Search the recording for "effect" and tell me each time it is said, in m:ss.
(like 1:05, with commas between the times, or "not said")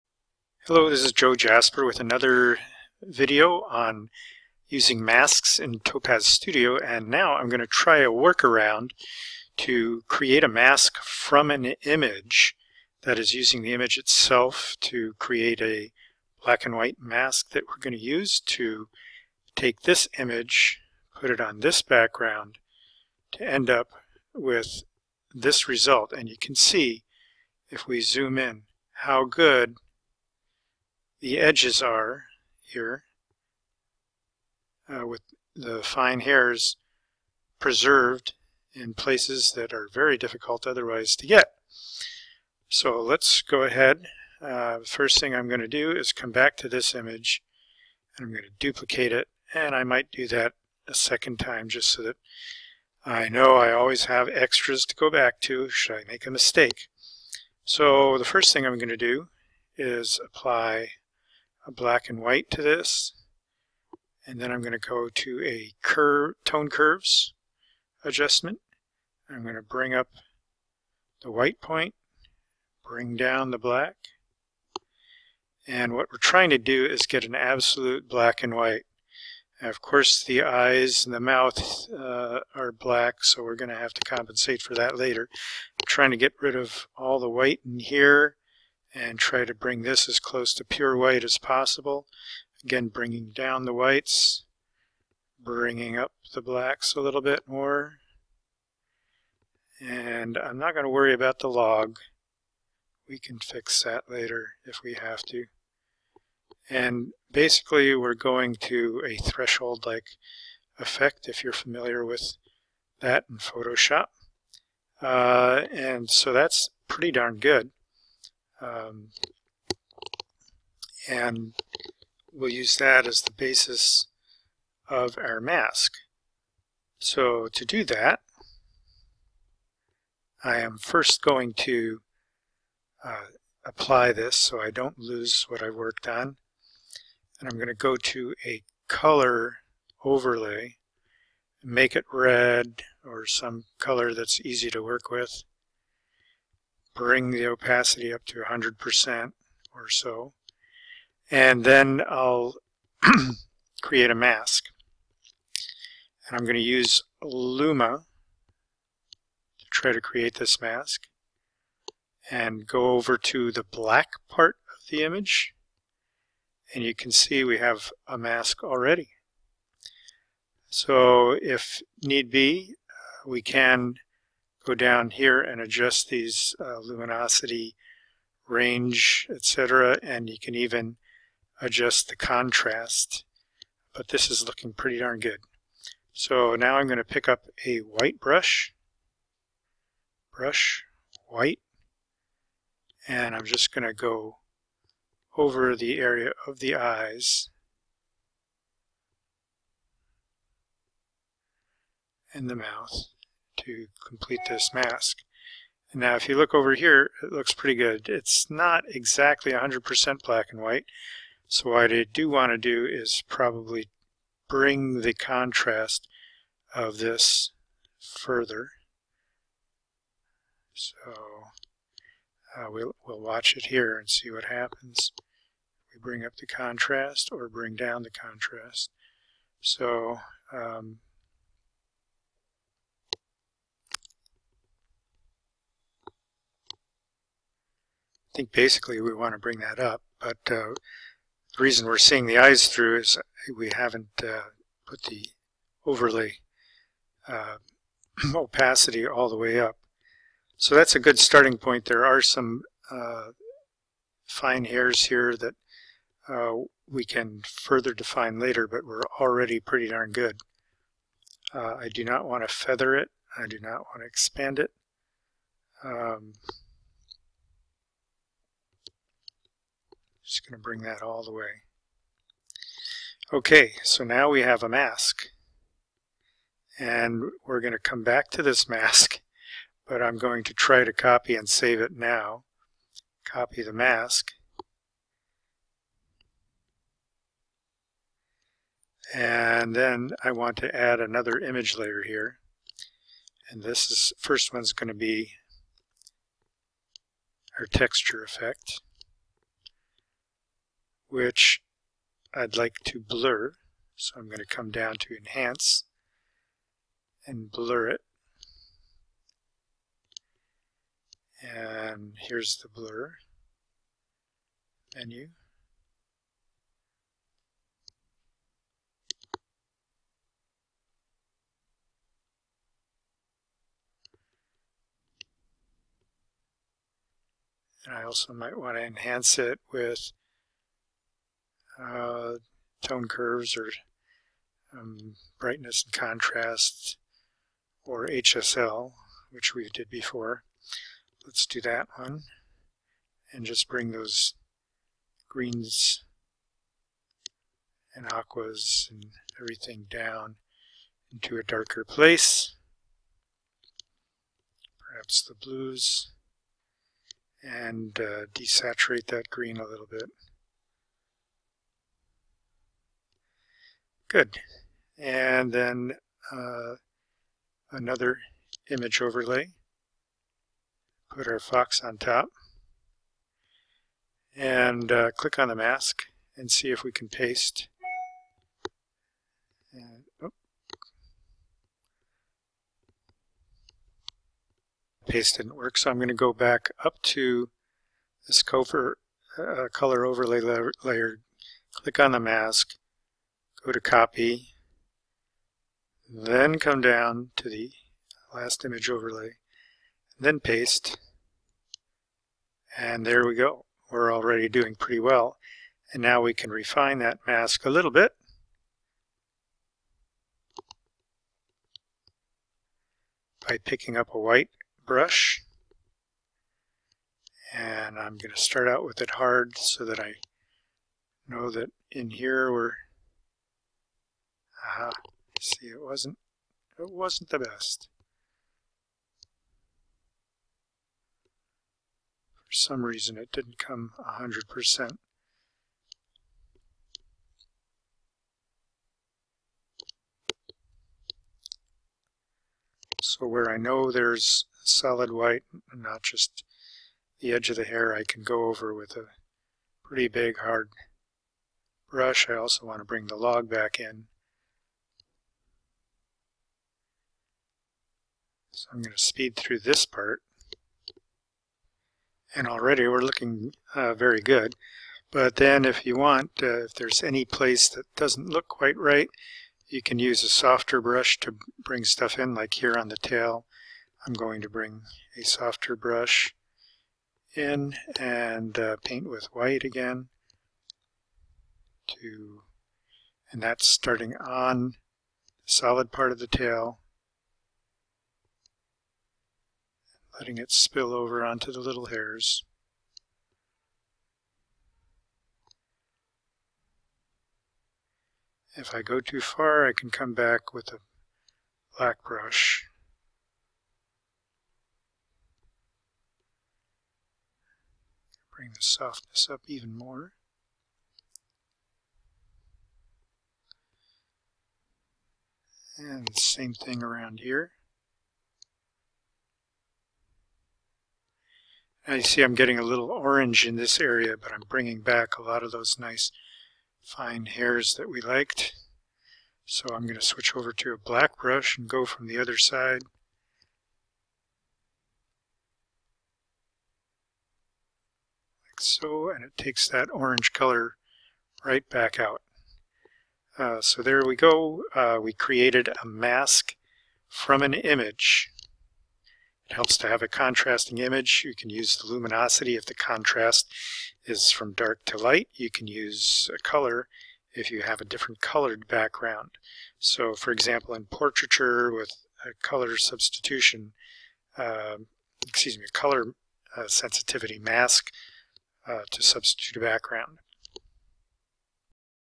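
1:50, 4:58.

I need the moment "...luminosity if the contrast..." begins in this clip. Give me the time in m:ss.
9:11.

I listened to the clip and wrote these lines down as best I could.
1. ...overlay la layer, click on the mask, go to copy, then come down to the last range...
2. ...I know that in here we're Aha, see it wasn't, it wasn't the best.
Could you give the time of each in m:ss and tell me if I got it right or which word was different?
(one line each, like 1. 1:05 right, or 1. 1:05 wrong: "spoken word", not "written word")
1. 6:30 wrong: "image", not "range"
2. 6:59 right.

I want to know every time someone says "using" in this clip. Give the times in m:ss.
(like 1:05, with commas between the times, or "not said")
0:04, 0:13.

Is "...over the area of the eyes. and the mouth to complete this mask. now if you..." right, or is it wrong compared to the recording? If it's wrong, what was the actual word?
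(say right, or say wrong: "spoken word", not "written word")
right.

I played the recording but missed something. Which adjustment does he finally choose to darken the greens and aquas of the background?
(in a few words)
HSL.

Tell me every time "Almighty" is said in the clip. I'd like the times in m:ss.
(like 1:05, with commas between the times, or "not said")
not said.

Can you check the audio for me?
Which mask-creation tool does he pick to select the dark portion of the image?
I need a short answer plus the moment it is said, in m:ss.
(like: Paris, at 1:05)
Luma, at 2:37.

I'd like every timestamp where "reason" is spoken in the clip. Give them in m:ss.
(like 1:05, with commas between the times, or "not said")
4:01, 7:12.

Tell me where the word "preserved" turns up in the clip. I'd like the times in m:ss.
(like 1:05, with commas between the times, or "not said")
0:37.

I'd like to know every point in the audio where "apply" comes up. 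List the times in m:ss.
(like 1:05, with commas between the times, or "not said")
1:00, 2:13.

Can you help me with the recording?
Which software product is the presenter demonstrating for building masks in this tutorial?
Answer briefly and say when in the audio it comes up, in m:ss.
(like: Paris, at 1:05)
Topaz Studio, at 0:05.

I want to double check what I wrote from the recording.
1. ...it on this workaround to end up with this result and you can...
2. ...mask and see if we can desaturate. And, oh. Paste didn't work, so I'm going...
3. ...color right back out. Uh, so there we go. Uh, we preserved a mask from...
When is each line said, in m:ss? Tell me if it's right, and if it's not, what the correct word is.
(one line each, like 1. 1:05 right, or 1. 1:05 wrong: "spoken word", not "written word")
1. 0:21 wrong: "background", not "workaround"
2. 6:15 wrong: "paste", not "desaturate"
3. 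9:00 wrong: "created", not "preserved".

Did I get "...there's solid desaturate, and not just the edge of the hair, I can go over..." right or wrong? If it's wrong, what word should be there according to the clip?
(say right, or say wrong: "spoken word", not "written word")
wrong: "white", not "desaturate".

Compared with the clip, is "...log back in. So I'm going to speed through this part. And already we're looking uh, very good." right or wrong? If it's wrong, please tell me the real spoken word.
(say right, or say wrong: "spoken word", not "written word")
right.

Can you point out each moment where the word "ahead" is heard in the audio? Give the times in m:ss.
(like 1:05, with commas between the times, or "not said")
0:43.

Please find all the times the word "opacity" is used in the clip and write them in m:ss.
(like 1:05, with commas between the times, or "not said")
2:27, 4:08.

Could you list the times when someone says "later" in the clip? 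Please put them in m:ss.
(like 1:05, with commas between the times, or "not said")
1:24, 1:44, 4:18.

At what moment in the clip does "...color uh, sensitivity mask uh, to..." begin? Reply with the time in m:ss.
9:25.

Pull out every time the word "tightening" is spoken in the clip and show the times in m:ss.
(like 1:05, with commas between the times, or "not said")
not said.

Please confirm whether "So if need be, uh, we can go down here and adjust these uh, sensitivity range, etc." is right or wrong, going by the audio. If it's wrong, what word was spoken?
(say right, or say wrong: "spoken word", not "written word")
wrong: "luminosity", not "sensitivity".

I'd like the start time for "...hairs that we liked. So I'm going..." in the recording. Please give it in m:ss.
8:47.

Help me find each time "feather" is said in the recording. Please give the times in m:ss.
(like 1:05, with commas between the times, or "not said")
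4:22.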